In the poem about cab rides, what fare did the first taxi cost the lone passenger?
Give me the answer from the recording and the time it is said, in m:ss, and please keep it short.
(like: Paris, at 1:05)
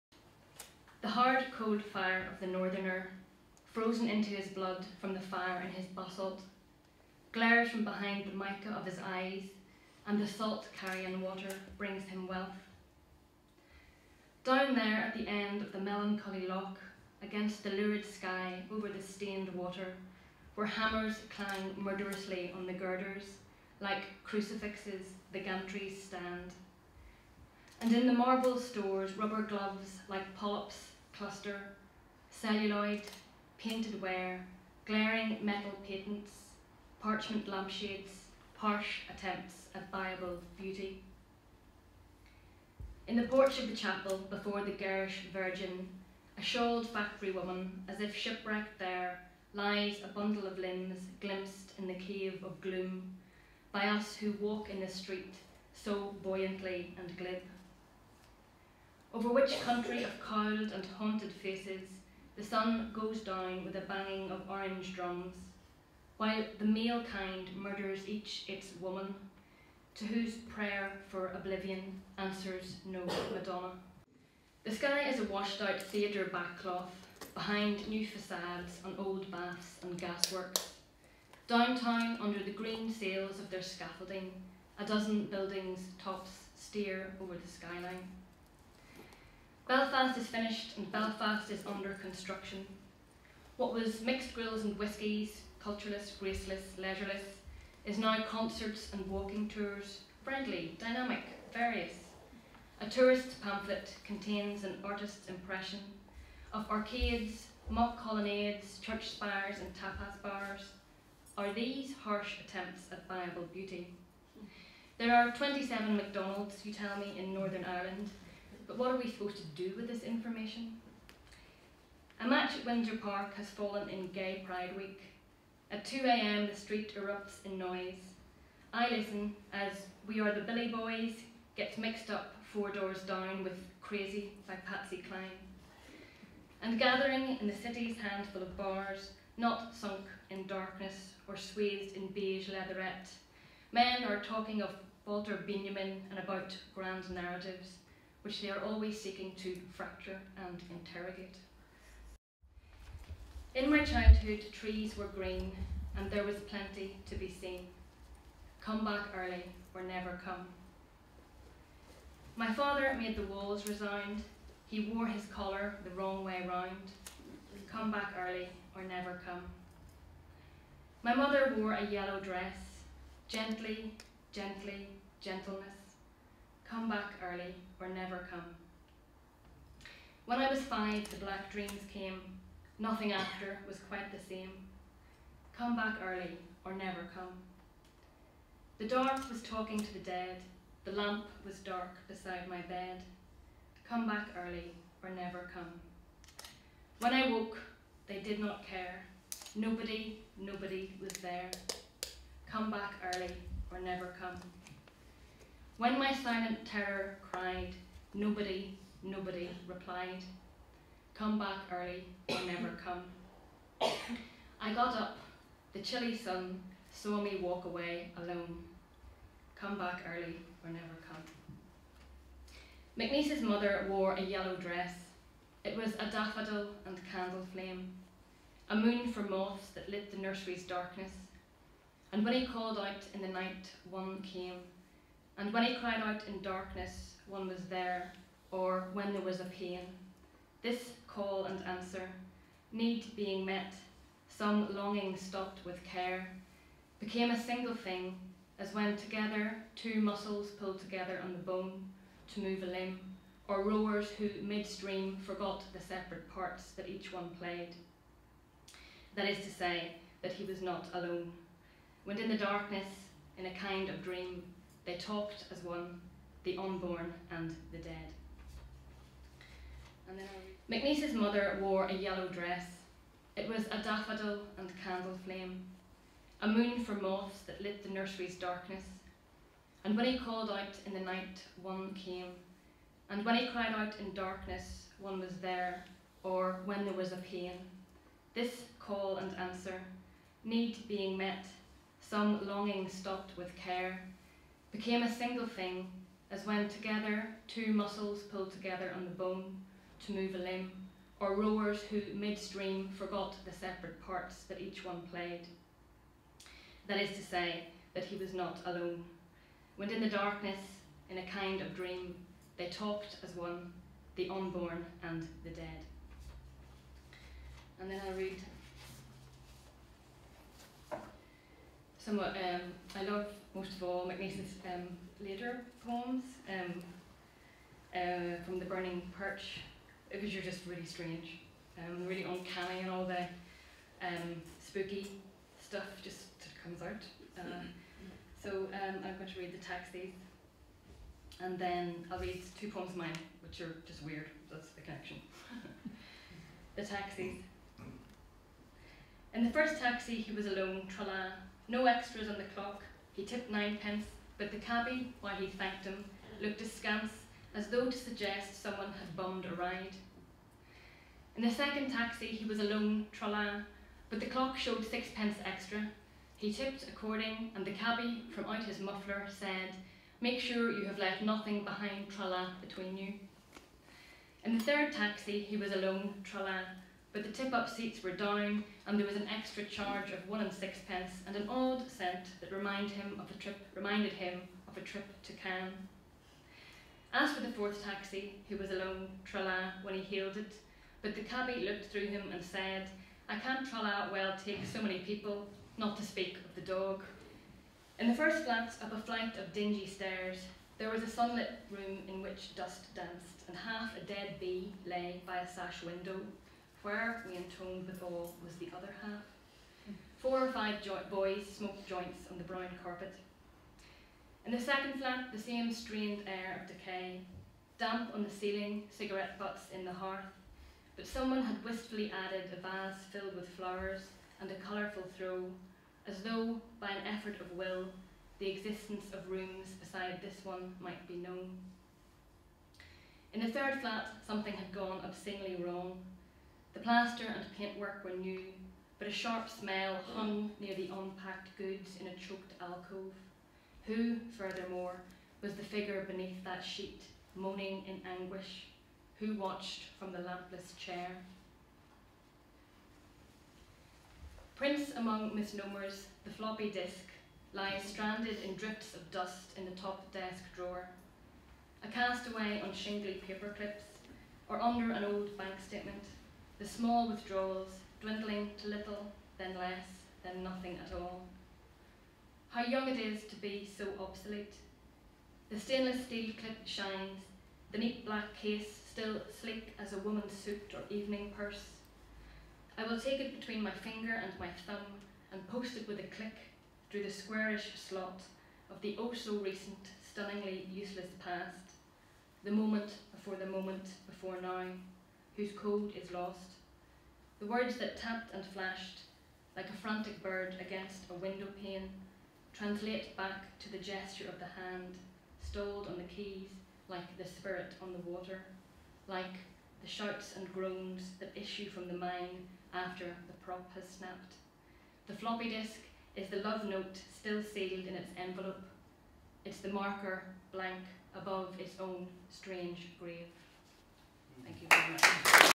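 ninepence, at 5:53.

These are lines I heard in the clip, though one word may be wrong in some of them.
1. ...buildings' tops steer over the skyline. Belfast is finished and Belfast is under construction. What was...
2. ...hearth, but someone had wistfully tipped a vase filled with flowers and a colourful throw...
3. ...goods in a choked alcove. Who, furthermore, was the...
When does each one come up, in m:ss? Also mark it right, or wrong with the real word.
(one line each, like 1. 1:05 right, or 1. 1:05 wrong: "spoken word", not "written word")
1. 1:25 right
2. 6:59 wrong: "added", not "tipped"
3. 7:21 right.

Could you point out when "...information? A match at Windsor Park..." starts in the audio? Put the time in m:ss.
2:00.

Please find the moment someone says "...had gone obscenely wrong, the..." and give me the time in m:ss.
7:14.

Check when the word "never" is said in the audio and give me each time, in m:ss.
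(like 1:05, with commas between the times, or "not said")
2:39, 2:48, 2:57, 3:06, 3:15, 3:23, 3:32, 3:40.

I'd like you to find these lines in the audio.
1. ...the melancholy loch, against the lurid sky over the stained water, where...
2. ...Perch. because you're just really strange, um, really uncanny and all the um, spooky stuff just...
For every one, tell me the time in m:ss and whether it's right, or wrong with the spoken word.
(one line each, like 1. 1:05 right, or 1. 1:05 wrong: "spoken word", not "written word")
1. 0:15 right
2. 5:29 right.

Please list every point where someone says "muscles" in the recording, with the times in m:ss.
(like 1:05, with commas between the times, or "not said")
4:09, 4:57.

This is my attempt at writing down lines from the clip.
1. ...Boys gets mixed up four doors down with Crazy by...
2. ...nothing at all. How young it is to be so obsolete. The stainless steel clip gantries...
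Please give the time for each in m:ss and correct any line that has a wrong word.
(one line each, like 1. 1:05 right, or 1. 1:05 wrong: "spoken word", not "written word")
1. 2:10 right
2. 7:50 wrong: "shines", not "gantries".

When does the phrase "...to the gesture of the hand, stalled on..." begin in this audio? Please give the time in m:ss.
8:23.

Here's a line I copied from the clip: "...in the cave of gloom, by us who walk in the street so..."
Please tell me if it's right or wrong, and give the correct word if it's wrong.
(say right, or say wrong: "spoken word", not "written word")
right.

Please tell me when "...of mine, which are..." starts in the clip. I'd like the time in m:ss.
5:42.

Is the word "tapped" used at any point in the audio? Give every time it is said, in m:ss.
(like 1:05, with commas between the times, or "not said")
8:17.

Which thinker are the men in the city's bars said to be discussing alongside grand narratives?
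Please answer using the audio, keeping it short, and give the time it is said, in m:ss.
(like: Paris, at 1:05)
Walter Benjamin, at 2:25.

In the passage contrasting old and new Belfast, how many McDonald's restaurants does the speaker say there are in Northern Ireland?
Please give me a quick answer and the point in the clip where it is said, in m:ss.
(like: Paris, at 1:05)
27, at 1:55.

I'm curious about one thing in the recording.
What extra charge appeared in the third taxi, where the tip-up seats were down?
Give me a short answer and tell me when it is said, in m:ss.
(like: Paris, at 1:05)
one and sixpence, at 6:20.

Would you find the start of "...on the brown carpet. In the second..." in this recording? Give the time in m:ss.
6:52.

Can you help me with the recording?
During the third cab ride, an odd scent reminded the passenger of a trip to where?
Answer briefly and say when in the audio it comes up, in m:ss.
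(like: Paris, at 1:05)
Cannes, at 6:25.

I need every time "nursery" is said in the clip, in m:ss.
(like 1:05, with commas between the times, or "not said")
3:50, 4:37.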